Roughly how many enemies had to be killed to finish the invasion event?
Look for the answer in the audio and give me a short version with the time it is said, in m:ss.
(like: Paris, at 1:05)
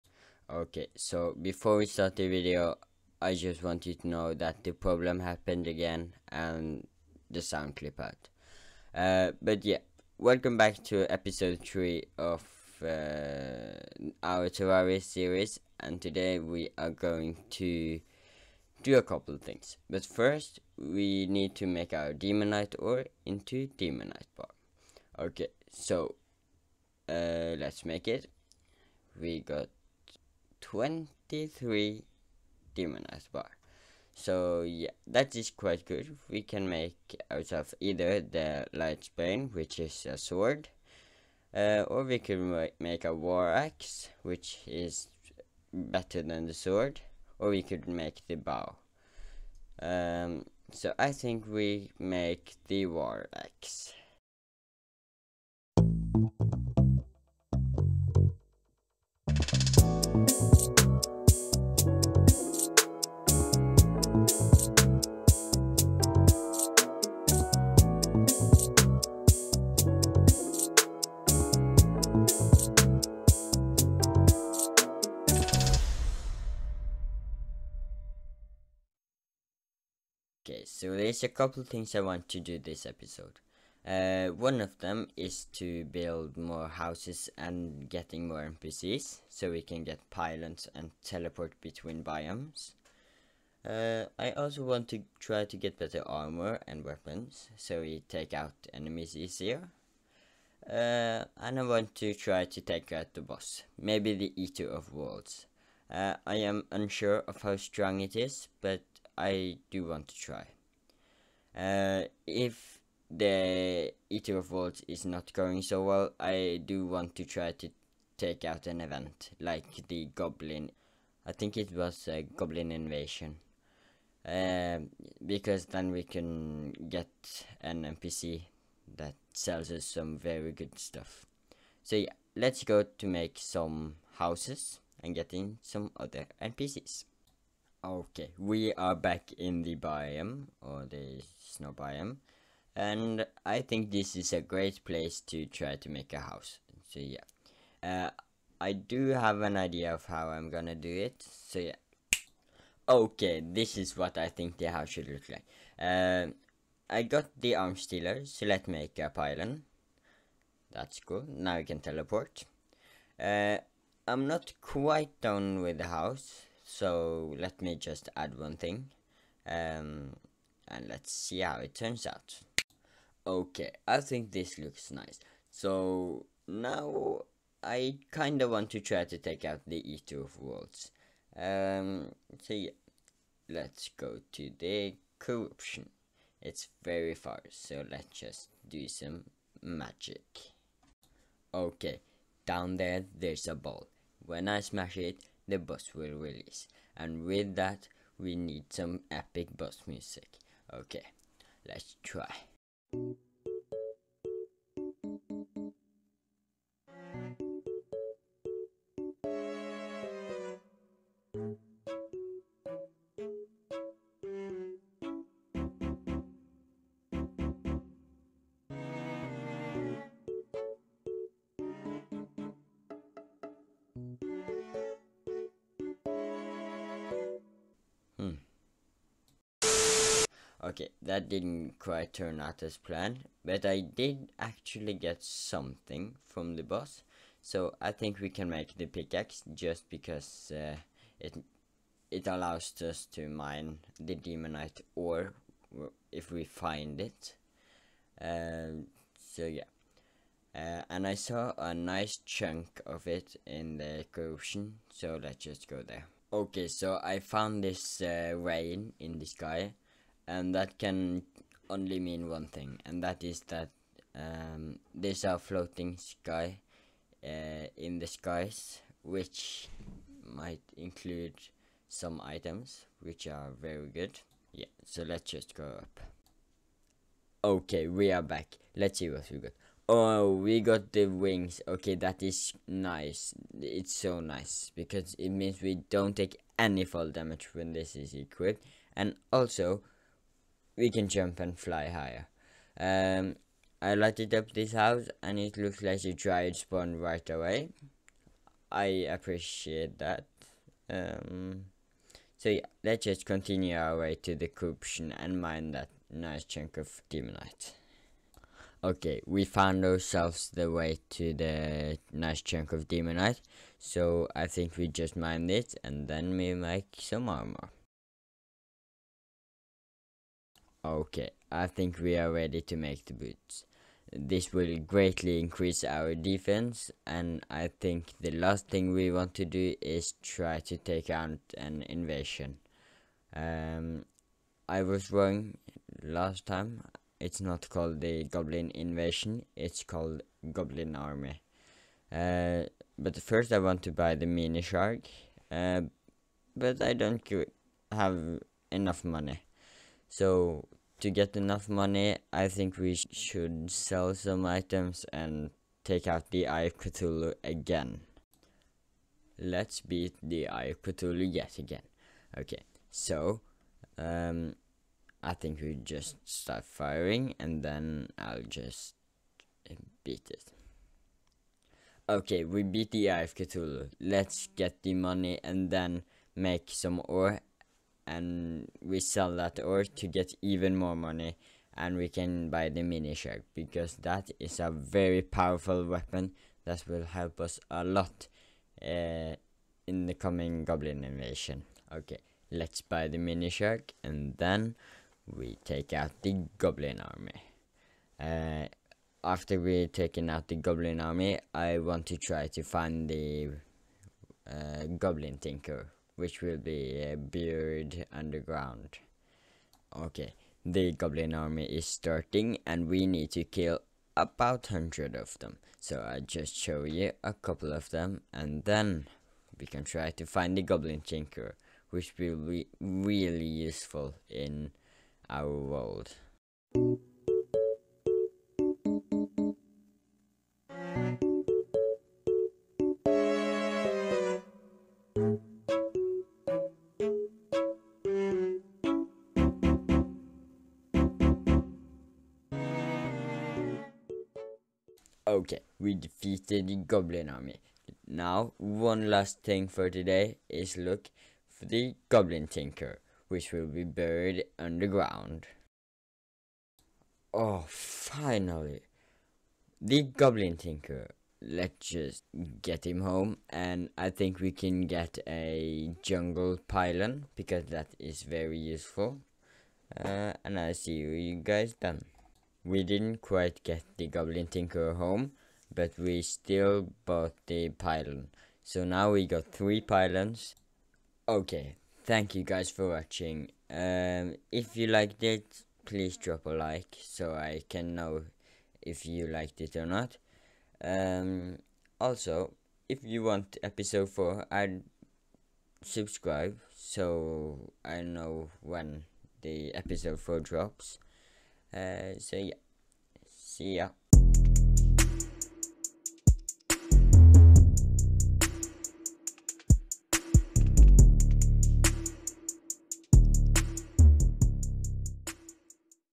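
100, at 6:54.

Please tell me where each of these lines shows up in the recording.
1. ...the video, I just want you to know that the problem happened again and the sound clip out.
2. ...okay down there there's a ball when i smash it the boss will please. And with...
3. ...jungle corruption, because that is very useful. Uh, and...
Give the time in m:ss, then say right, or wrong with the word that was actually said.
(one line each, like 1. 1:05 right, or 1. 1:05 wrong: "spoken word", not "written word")
1. 0:02 right
2. 3:11 wrong: "release", not "please"
3. 7:46 wrong: "pylon", not "corruption".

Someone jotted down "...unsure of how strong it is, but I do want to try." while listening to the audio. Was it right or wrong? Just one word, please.
right.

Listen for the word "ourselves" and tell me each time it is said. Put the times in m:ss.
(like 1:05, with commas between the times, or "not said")
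5:09.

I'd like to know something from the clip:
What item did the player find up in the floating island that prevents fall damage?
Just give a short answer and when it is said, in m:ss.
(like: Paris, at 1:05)
Wings, at 4:41.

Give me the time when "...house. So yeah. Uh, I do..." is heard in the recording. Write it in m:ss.
2:26.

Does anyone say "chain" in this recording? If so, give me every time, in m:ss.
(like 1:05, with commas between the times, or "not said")
not said.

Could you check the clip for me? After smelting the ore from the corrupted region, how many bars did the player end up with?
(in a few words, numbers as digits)
23.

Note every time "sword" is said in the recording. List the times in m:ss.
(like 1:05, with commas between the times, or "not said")
0:40, 0:46.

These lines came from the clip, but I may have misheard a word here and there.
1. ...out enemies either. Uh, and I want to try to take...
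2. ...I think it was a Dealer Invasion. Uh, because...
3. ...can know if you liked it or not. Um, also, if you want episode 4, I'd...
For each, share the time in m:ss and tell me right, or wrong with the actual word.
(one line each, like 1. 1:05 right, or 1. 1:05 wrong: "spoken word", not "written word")
1. 1:38 wrong: "easier", not "either"
2. 2:01 wrong: "Goblin", not "Dealer"
3. 8:07 right.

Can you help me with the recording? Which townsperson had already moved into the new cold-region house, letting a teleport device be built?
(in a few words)
Arms Dealer.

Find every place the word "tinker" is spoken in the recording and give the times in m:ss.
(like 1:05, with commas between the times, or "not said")
6:45, 7:01, 7:32, 7:40, 7:54.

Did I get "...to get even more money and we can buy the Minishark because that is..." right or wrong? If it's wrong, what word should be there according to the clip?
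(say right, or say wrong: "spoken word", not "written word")
right.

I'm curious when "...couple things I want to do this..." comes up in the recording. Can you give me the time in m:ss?
1:21.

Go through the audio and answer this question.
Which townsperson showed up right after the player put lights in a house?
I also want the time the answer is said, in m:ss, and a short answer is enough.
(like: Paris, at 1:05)
Dryad, at 4:56.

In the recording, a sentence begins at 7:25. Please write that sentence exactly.
Okay, we defeated the goblin army.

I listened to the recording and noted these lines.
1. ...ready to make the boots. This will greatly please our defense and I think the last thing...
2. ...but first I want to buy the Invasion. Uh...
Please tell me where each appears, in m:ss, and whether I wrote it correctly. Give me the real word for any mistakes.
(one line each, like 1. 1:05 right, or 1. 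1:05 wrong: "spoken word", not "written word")
1. 5:22 wrong: "increase", not "please"
2. 5:42 wrong: "Minishark", not "Invasion".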